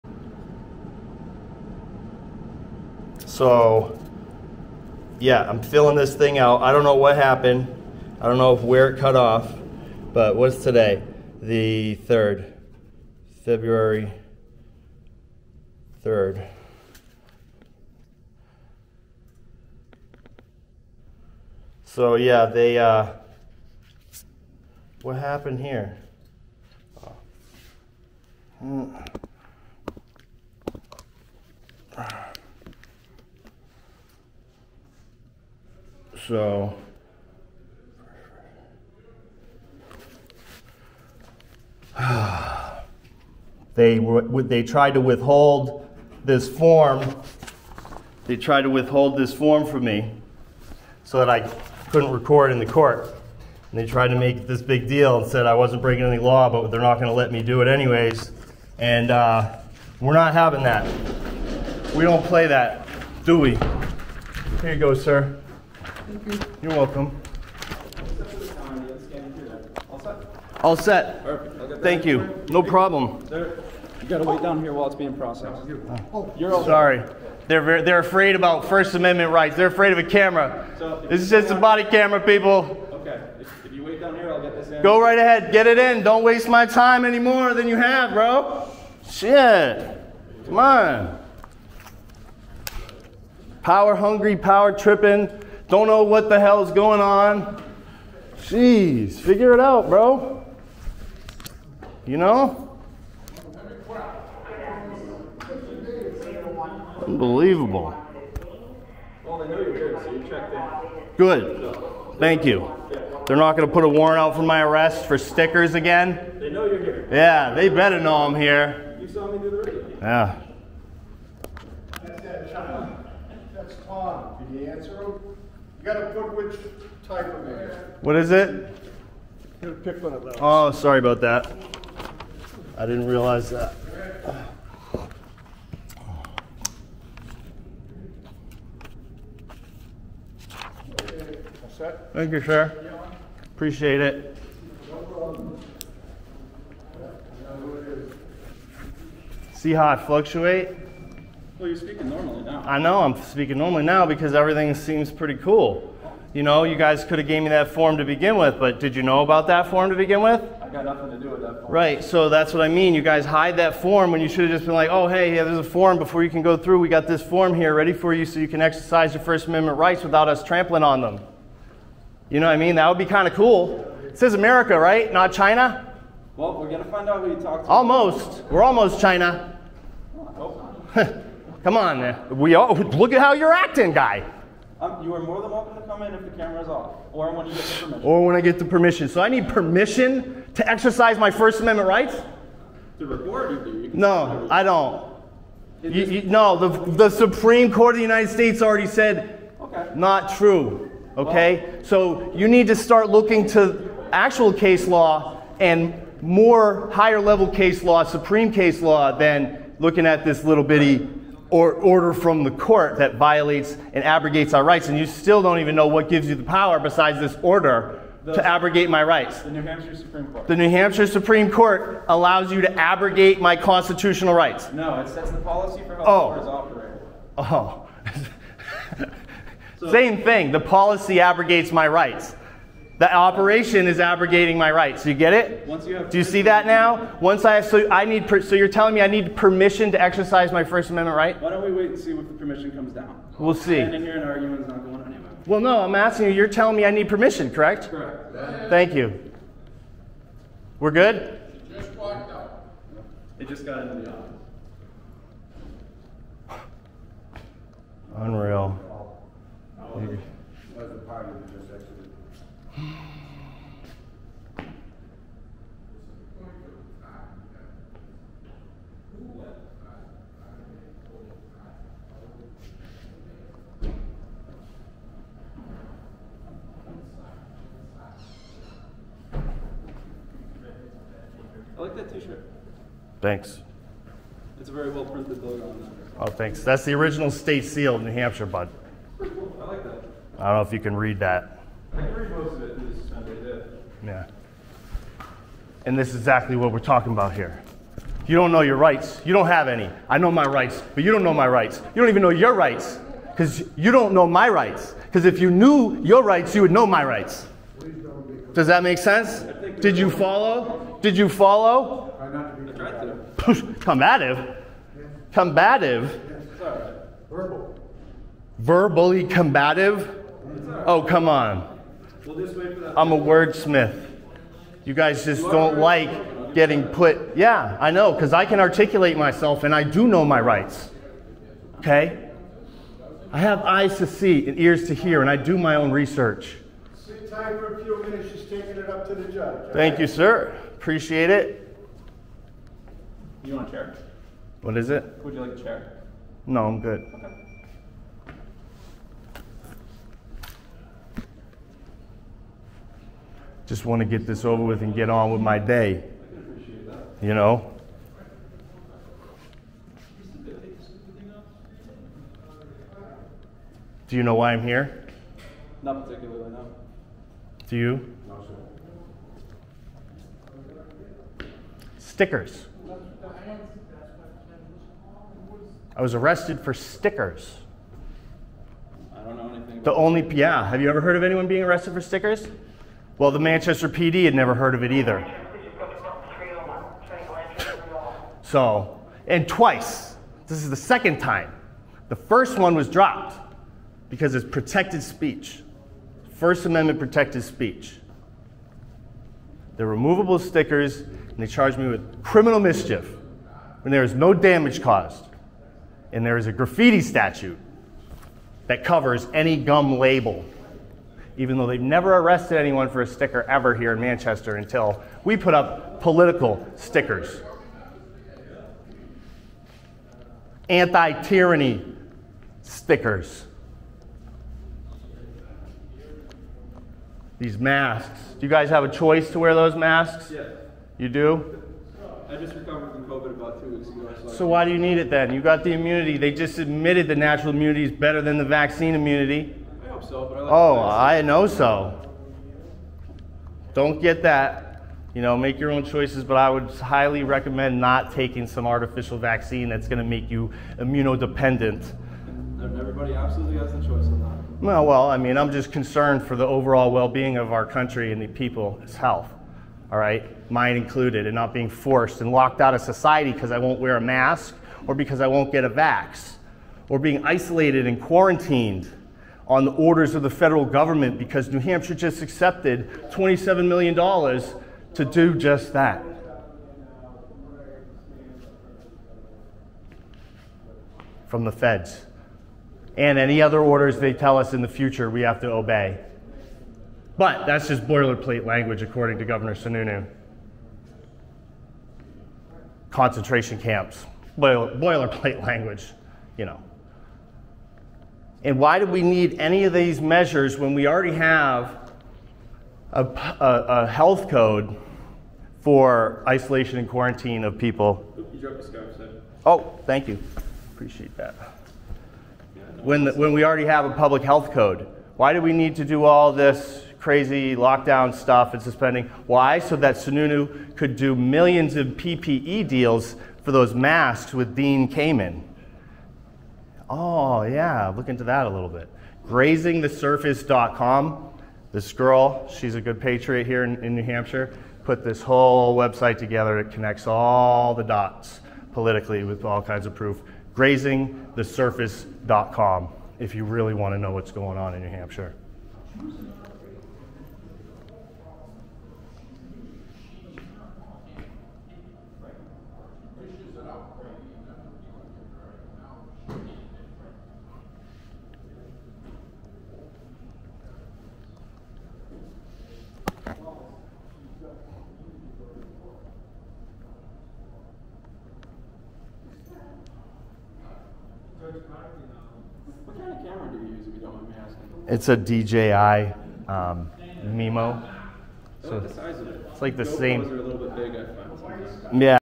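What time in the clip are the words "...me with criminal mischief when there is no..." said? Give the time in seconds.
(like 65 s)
401 s.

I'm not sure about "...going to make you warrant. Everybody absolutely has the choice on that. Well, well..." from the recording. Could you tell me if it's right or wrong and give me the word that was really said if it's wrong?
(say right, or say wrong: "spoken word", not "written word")
wrong: "immunodependent", not "warrant".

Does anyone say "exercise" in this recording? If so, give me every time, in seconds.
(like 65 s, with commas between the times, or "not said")
168 s, 190 s, 239 s.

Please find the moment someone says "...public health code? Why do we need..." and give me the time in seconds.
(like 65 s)
513 s.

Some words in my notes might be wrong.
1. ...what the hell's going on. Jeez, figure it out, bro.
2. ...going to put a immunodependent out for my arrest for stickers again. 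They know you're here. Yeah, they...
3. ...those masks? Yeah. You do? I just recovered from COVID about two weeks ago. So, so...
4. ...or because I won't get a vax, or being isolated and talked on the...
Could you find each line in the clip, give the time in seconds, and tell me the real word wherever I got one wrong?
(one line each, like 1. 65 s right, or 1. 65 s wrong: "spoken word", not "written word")
1. 96 s right
2. 113 s wrong: "warrant", not "immunodependent"
3. 429 s right
4. 464 s wrong: "quarantined", not "talked".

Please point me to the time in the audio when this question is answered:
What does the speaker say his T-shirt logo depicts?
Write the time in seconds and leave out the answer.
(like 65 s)
286 s.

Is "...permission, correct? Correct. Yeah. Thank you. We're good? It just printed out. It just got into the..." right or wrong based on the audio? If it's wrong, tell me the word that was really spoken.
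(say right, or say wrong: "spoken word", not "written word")
wrong: "walked", not "printed".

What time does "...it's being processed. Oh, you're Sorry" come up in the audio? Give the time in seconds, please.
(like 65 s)
74 s.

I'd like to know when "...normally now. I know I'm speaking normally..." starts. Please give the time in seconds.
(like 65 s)
152 s.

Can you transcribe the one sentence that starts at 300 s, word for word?
I know my rights, but you don't know my rights.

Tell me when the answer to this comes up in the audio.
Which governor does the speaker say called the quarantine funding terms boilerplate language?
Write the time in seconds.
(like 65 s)
489 s.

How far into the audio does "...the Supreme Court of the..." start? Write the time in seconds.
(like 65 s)
196 s.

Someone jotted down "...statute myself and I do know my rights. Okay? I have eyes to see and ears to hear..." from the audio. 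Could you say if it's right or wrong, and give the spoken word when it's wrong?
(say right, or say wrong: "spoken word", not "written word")
wrong: "articulate", not "statute".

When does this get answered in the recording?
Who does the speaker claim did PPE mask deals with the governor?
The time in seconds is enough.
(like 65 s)
524 s.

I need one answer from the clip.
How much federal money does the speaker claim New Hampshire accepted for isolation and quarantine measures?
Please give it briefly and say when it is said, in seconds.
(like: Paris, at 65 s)
$27 million, at 473 s.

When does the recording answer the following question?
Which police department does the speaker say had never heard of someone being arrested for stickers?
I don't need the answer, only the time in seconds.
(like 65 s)
383 s.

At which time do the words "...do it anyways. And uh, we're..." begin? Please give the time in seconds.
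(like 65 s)
57 s.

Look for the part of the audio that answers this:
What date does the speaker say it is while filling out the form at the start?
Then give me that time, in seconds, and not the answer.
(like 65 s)
13 s.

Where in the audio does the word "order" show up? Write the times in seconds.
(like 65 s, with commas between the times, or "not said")
211 s, 217 s, 469 s, 483 s.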